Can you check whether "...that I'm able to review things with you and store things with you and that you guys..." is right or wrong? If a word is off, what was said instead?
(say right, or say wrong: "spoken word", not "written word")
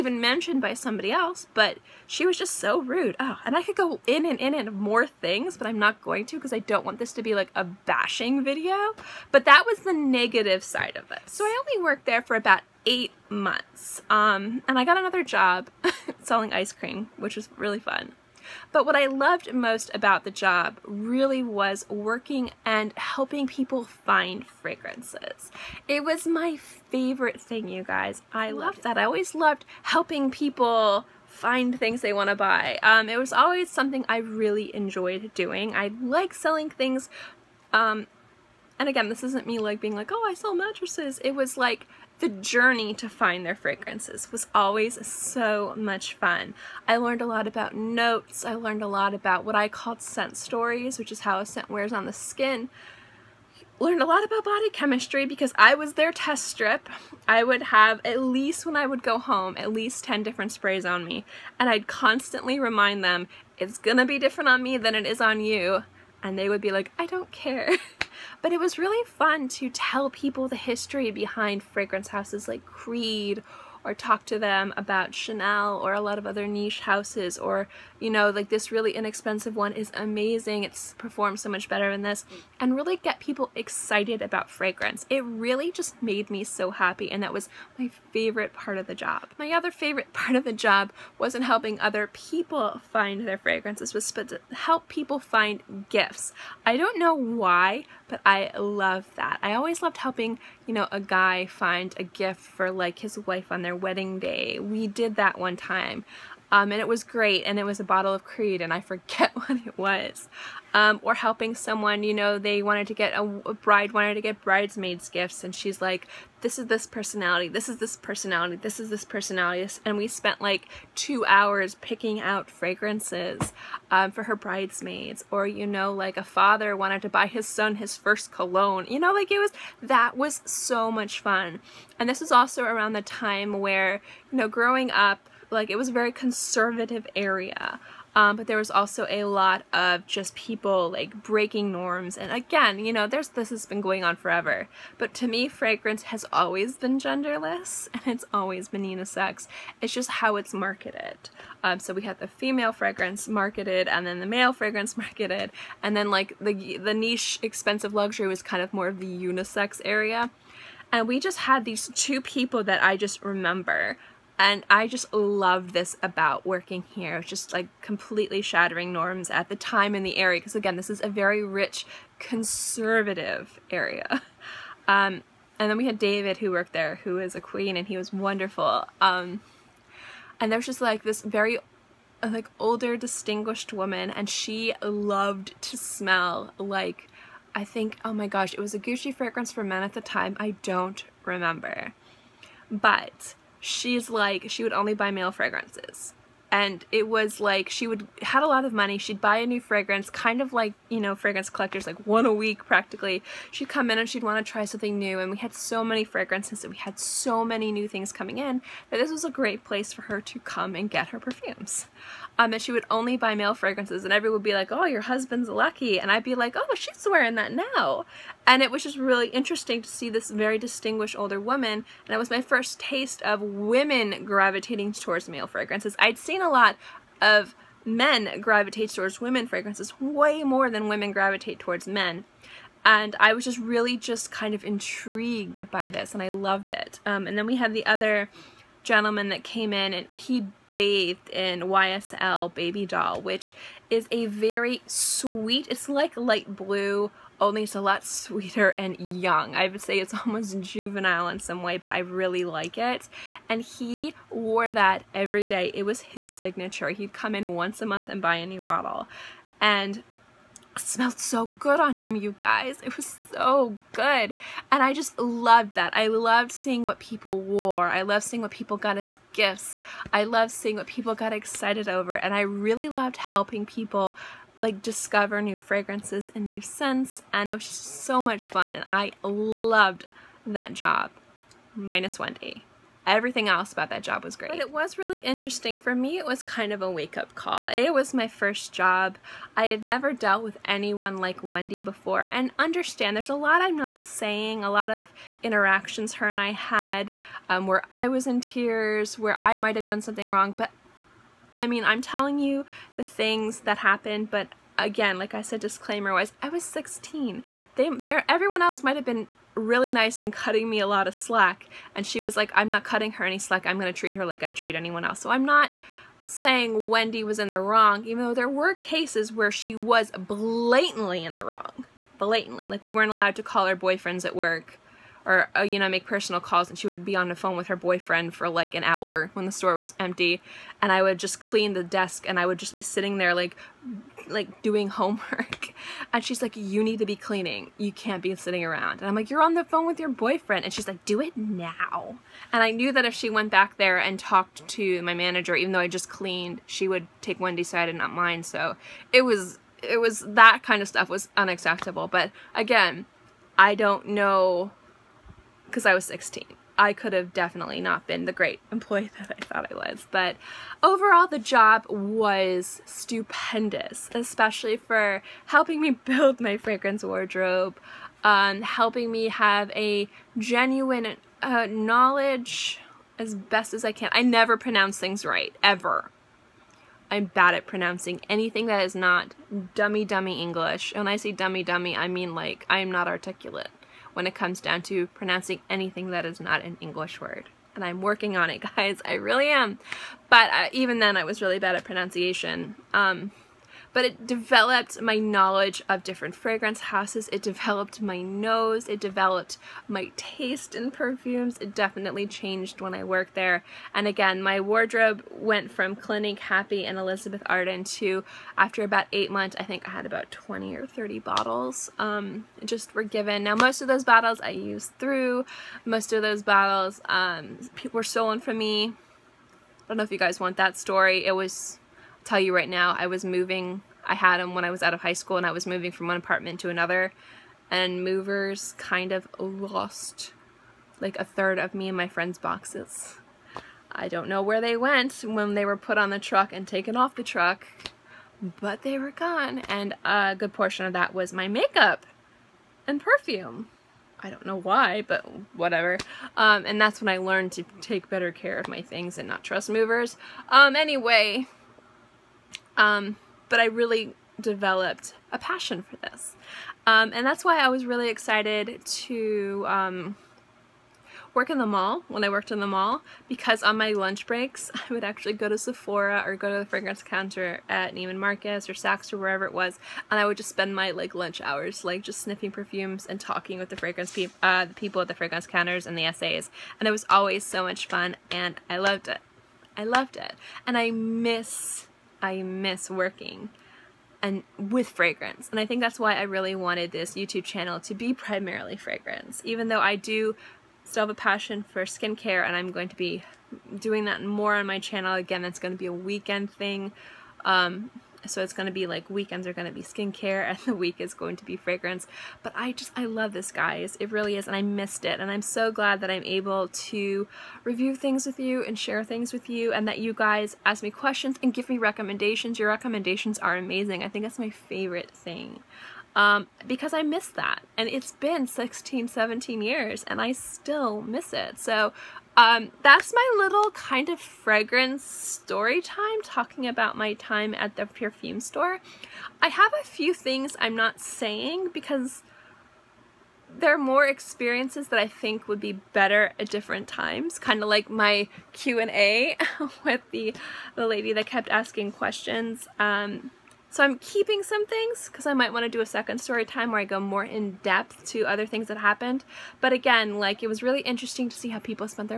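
wrong: "share", not "store".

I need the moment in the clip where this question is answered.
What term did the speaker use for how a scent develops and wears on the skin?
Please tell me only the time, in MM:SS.
00:50.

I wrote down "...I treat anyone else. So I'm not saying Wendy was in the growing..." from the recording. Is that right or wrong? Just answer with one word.
wrong.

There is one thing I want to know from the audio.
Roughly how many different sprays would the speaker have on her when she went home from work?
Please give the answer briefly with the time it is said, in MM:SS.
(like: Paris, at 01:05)
10, at 01:00.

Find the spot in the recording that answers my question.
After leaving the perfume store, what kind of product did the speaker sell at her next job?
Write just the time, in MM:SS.
00:16.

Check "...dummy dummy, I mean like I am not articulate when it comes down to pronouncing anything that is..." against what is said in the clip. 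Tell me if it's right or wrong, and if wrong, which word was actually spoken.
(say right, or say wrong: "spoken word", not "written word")
right.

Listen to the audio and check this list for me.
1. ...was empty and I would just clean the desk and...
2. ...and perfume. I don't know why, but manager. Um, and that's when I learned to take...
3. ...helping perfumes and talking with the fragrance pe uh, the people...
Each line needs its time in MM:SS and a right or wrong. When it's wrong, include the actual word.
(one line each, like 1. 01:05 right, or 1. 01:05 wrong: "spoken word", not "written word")
1. 05:29 right
2. 07:22 wrong: "whatever", not "manager"
3. 07:52 wrong: "sniffing", not "helping".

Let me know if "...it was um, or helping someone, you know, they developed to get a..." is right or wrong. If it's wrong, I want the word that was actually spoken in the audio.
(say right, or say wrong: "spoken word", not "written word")
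wrong: "wanted", not "developed".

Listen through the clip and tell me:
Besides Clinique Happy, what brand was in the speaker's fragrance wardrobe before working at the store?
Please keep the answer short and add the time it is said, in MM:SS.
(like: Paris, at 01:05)
Elizabeth Arden, at 06:46.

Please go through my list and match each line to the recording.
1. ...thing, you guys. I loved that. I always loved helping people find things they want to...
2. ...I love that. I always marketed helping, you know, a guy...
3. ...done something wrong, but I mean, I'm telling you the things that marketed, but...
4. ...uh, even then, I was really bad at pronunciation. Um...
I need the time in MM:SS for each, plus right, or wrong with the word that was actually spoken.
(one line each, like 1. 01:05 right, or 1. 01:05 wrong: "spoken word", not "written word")
1. 00:27 right
2. 01:38 wrong: "loved", not "marketed"
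3. 04:59 wrong: "happened", not "marketed"
4. 06:30 right.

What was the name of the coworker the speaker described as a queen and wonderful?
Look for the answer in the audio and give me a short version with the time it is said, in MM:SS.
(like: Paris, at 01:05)
David, at 02:55.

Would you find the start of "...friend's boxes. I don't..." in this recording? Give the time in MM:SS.
07:12.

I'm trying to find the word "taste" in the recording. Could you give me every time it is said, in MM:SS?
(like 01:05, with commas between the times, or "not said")
03:42, 06:40.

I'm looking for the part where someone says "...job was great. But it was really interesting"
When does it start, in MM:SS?
04:44.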